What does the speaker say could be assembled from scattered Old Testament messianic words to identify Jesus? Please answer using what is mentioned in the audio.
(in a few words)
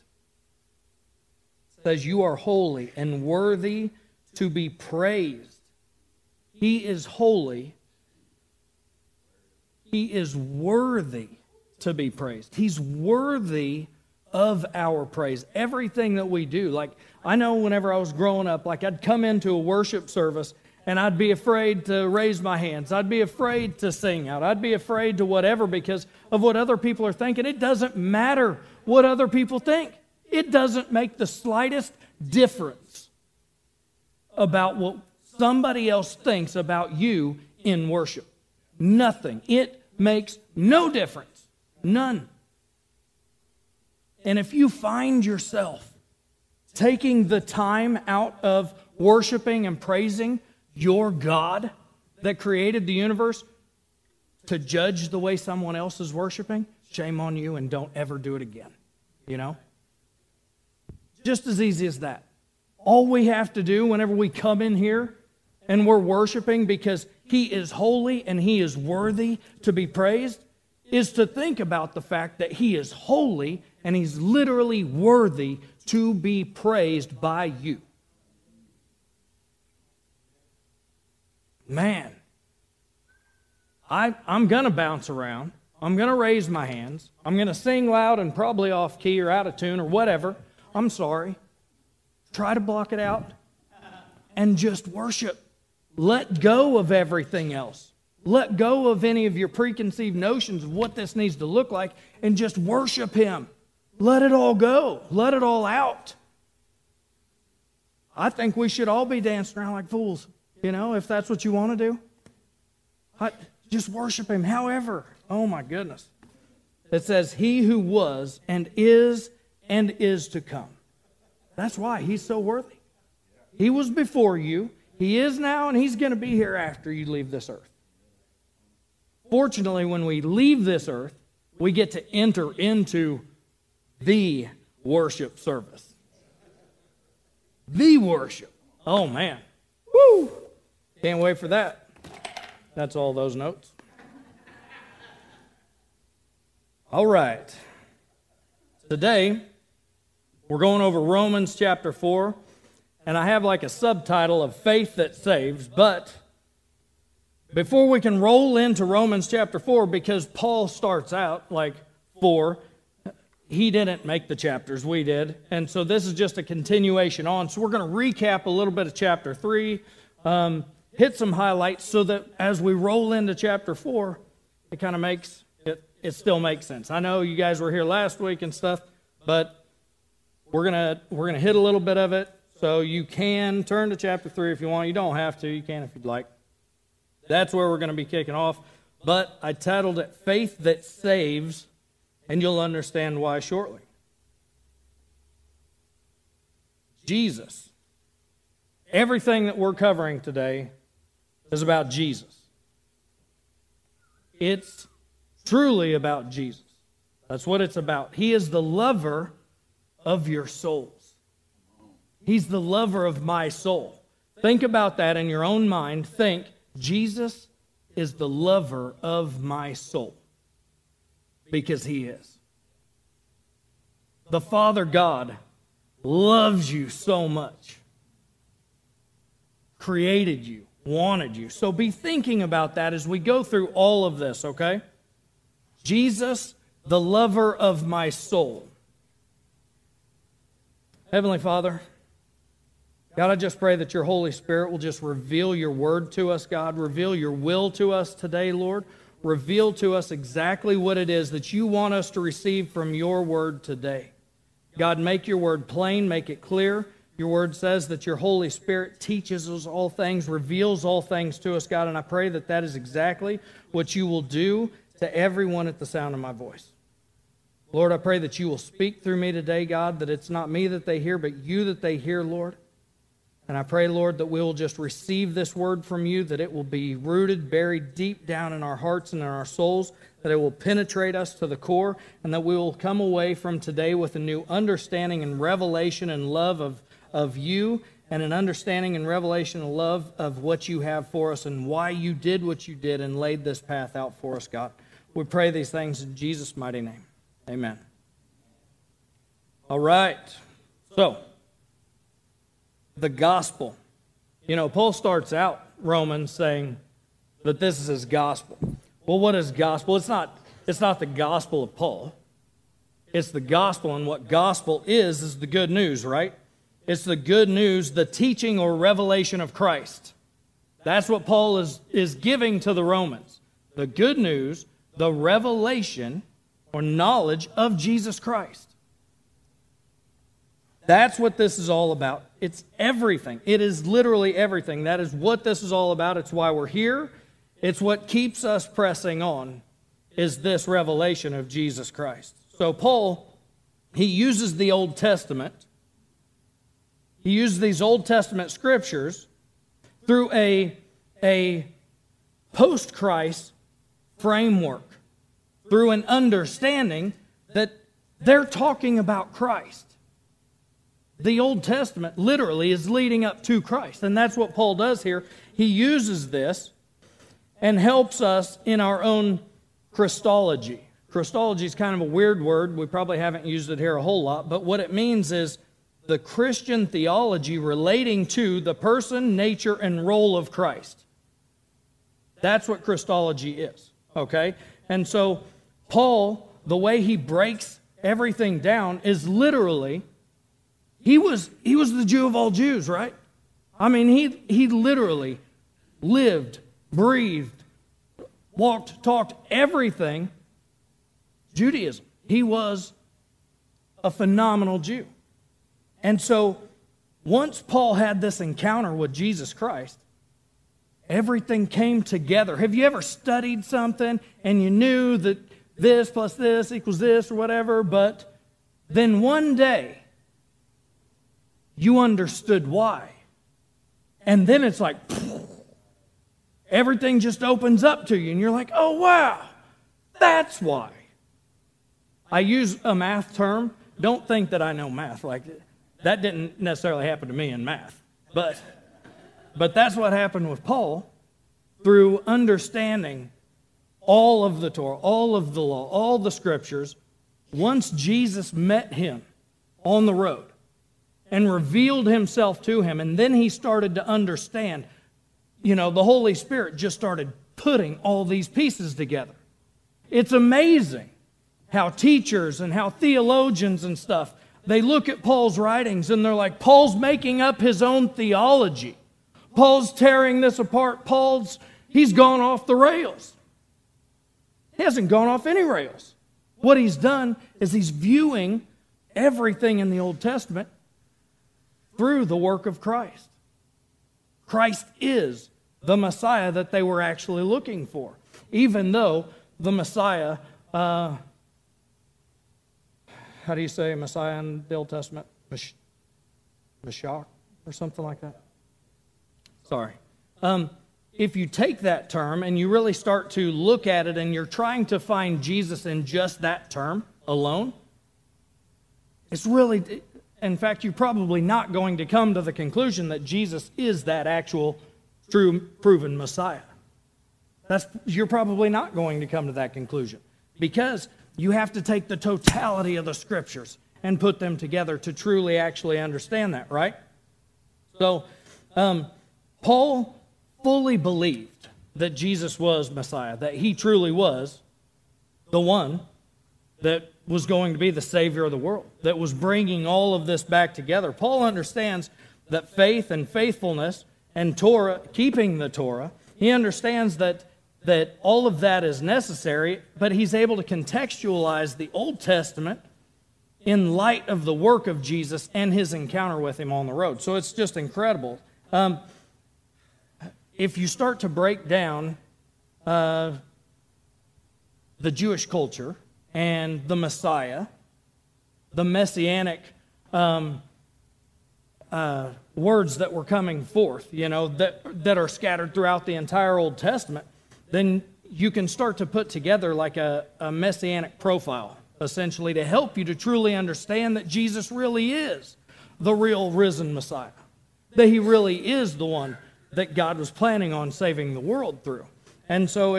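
a messianic profile.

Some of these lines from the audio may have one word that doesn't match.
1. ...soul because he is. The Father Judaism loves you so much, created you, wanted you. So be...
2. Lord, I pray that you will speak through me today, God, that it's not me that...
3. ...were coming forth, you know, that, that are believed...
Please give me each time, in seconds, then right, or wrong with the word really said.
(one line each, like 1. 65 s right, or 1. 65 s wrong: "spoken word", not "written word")
1. 219 s wrong: "God", not "Judaism"
2. 267 s right
3. 573 s wrong: "scattered", not "believed".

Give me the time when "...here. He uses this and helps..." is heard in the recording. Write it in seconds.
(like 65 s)
365 s.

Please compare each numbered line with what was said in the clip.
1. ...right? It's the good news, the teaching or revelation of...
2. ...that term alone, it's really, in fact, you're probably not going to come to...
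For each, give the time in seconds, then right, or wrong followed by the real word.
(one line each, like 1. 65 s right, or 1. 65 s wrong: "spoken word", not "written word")
1. 316 s right
2. 506 s right.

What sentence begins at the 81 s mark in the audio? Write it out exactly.
Man, I, am going to bounce around.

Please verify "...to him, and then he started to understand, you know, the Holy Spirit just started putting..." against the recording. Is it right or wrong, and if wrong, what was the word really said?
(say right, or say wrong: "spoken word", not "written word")
right.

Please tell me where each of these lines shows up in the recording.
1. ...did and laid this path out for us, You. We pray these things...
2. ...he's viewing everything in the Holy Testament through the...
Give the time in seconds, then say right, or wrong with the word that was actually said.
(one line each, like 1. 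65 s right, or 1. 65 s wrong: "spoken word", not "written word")
1. 292 s wrong: "God", not "You"
2. 477 s wrong: "Old", not "Holy".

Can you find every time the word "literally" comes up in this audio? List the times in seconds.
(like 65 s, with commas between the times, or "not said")
74 s, 333 s, 362 s, 389 s, 394 s.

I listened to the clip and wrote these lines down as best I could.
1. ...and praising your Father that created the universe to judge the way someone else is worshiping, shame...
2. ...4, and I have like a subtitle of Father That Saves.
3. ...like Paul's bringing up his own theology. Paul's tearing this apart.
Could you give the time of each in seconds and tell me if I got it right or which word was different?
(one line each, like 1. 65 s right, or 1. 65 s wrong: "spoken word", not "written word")
1. 49 s wrong: "God", not "Father"
2. 151 s wrong: "Faith", not "Father"
3. 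466 s wrong: "making", not "bringing".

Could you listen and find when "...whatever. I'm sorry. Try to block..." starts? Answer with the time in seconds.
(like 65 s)
89 s.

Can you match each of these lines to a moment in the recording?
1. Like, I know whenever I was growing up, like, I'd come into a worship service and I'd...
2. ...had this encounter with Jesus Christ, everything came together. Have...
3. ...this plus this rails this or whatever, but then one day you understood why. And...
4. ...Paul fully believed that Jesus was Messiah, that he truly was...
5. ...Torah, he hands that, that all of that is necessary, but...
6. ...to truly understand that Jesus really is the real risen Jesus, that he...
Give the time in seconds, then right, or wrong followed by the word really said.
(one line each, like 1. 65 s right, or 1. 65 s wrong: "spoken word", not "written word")
1. 16 s right
2. 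407 s right
3. 415 s wrong: "equals", not "rails"
4. 529 s right
5. 545 s wrong: "understands", not "hands"
6. 583 s wrong: "Messiah", not "Jesus".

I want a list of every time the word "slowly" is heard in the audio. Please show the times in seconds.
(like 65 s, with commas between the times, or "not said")
not said.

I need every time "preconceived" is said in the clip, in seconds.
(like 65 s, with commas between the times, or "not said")
99 s.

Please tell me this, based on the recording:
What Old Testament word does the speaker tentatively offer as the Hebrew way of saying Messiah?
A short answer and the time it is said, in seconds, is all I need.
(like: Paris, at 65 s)
Meshach, at 495 s.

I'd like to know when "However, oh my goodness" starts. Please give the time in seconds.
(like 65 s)
114 s.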